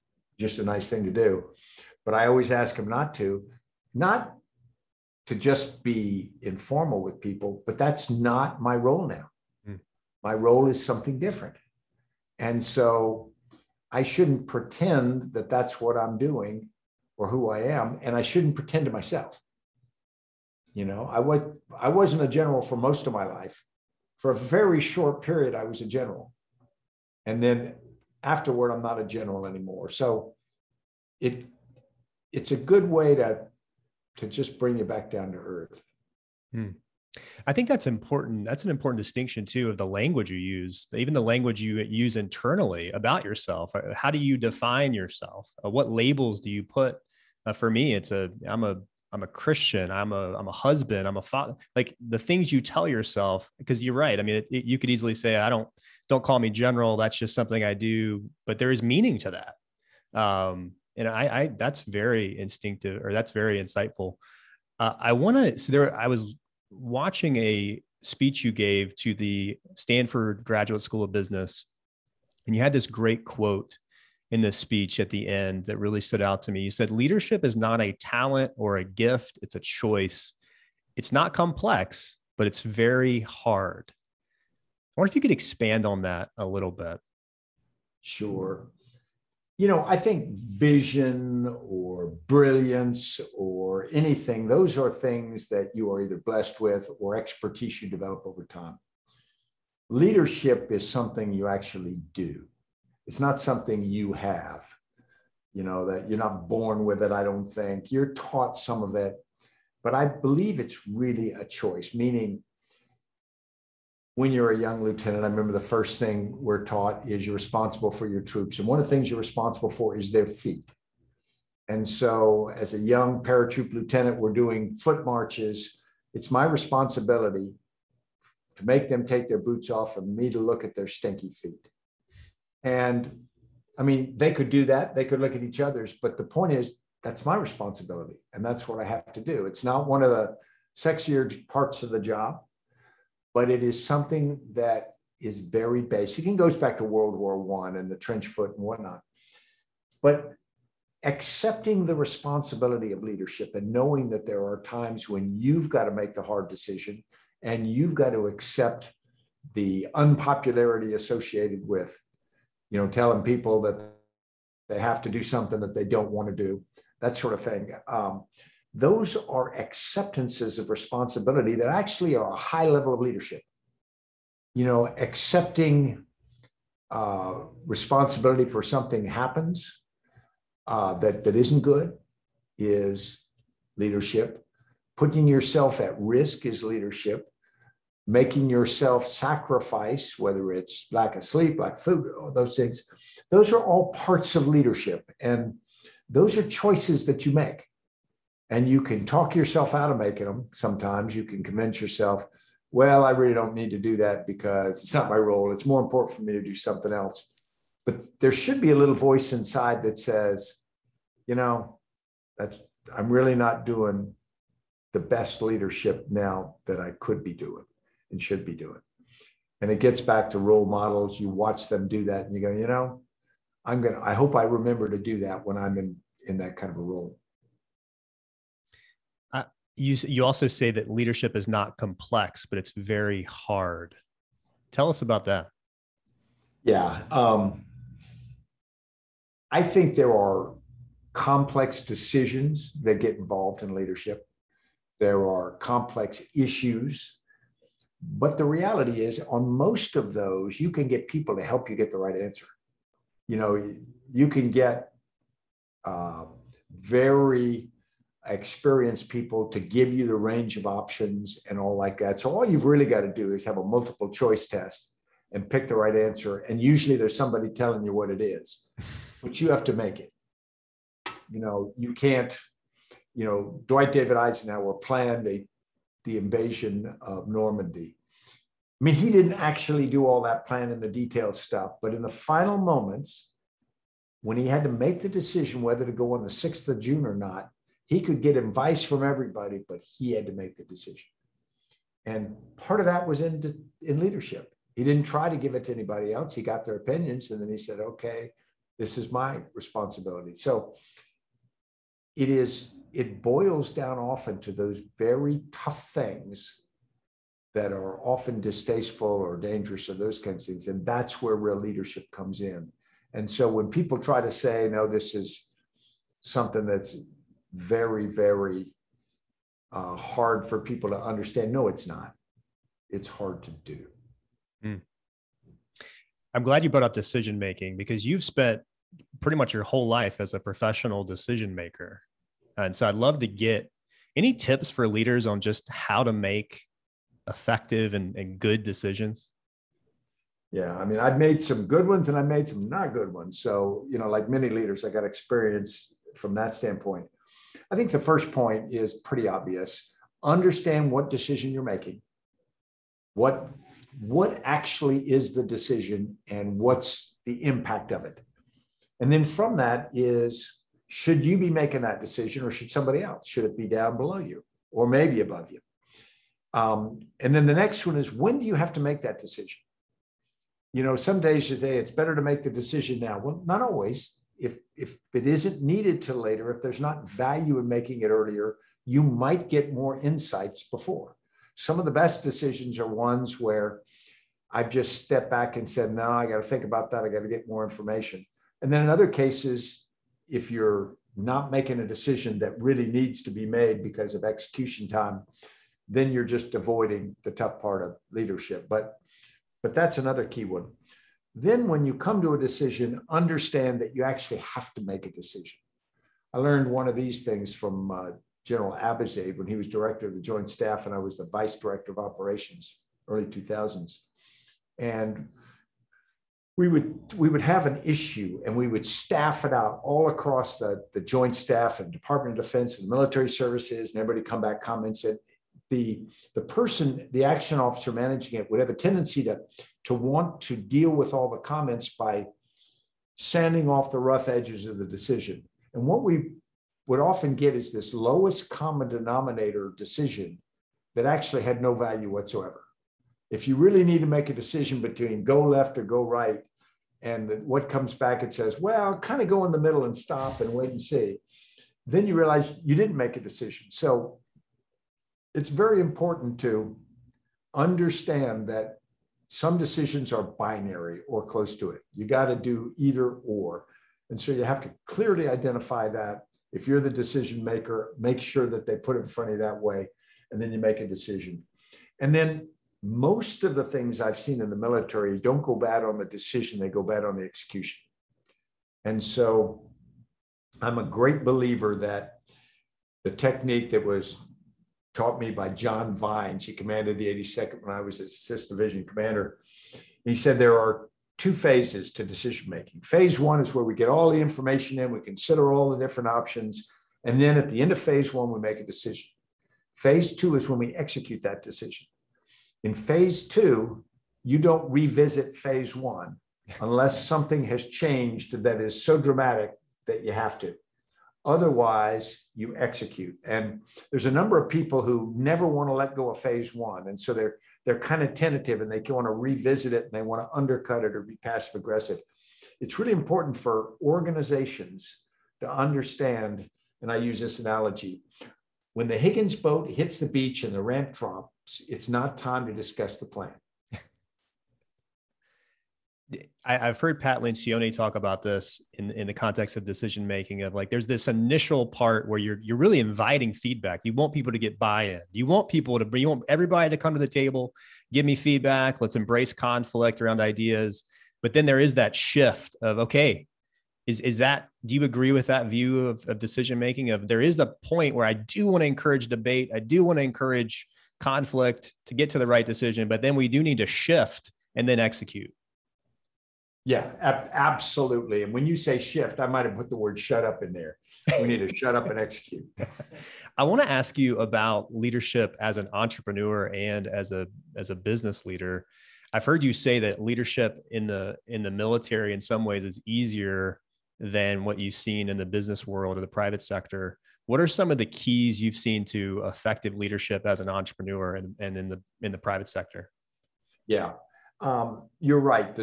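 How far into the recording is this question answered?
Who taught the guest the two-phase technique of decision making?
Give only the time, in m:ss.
8:05.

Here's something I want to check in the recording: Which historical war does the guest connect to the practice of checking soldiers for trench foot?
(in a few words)
World War One.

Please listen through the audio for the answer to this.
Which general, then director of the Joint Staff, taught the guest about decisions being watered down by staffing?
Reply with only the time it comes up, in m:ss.
6:48.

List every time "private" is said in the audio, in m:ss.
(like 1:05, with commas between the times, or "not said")
9:46, 9:52.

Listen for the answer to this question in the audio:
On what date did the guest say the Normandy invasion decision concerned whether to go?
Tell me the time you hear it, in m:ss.
4:46.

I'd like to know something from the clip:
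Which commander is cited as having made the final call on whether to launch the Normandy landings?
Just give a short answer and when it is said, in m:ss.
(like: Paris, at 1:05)
Dwight David Eisenhower, at 4:33.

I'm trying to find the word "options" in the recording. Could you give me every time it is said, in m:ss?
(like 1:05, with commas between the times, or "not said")
4:20, 8:16.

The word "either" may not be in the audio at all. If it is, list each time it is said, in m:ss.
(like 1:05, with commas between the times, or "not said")
1:36, 7:42.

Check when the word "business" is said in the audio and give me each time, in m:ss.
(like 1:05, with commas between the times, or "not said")
1:11, 9:37, 9:45.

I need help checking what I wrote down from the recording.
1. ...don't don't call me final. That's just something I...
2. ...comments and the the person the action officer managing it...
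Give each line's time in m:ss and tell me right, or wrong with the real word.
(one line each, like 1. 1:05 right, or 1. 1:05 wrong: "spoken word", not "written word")
1. 0:55 wrong: "general", not "final"
2. 7:04 right.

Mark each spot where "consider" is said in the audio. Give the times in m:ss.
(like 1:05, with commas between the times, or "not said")
8:15.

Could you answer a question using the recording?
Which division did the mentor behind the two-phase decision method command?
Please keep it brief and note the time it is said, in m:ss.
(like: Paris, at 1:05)
The 82nd, at 8:06.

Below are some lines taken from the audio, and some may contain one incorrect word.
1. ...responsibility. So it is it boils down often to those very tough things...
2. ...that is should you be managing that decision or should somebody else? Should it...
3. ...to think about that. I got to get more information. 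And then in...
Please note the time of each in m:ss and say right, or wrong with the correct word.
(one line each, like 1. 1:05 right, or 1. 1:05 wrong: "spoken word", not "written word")
1. 4:59 right
2. 5:59 wrong: "making", not "managing"
3. 6:26 right.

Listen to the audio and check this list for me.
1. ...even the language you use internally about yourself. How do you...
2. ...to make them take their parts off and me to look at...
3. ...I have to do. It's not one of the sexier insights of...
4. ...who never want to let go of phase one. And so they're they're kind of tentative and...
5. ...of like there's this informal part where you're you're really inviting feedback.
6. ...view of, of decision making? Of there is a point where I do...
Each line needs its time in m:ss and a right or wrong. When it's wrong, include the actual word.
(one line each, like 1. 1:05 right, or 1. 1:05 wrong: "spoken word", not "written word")
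1. 0:40 right
2. 2:08 wrong: "boots", not "parts"
3. 2:18 wrong: "parts", not "insights"
4. 8:34 right
5. 9:00 wrong: "initial", not "informal"
6. 9:15 right.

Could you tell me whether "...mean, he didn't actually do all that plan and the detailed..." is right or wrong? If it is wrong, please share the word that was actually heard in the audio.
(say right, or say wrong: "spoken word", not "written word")
right.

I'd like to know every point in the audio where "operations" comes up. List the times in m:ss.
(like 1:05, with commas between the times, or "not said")
6:51.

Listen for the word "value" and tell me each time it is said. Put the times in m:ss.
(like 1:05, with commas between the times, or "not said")
6:17, 7:21.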